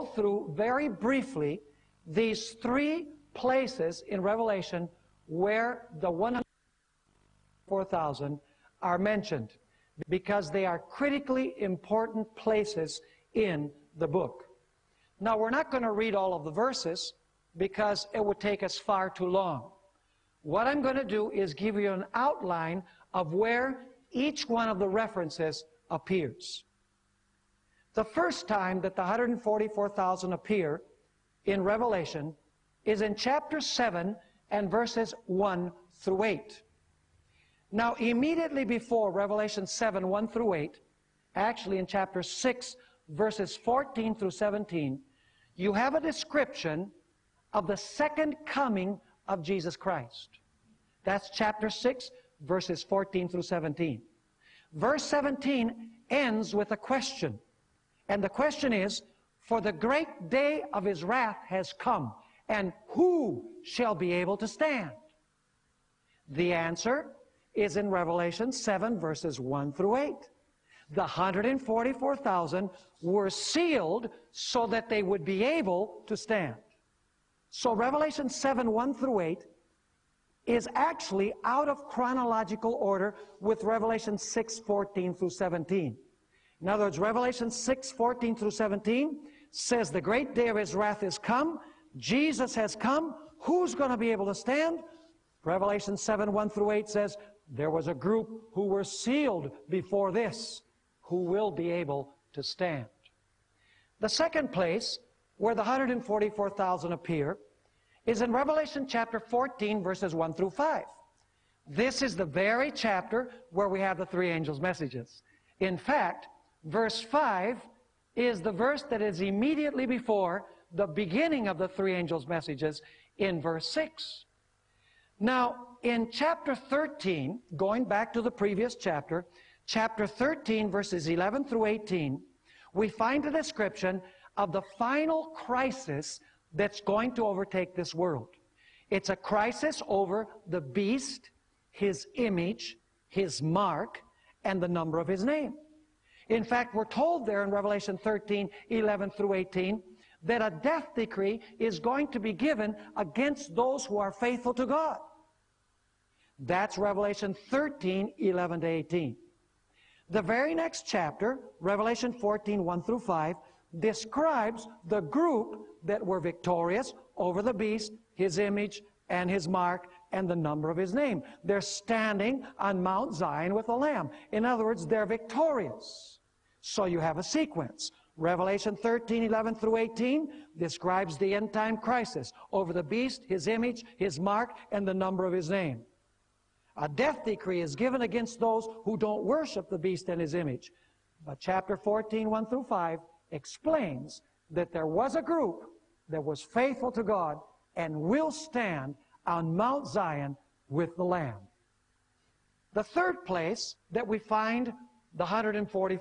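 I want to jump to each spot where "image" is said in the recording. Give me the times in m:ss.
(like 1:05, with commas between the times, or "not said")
2:22, 2:48, 3:03, 3:10.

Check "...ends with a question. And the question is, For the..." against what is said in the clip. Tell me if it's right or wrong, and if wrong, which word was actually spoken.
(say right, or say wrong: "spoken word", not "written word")
right.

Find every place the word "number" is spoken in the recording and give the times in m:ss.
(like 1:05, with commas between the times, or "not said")
2:24, 2:50, 3:04.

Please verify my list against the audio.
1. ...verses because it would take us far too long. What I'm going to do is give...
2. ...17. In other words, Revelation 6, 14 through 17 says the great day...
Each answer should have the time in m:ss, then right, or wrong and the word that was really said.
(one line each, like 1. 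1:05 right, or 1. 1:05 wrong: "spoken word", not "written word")
1. 0:16 right
2. 1:25 right.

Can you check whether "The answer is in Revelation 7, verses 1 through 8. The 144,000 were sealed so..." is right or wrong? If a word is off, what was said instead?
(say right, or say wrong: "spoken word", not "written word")
right.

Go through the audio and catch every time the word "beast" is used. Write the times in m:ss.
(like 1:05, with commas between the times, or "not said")
2:20, 2:47, 3:02, 3:09.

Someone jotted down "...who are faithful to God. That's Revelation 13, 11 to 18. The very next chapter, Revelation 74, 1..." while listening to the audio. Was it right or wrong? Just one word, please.
wrong.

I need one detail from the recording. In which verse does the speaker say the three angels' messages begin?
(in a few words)
Verse 6.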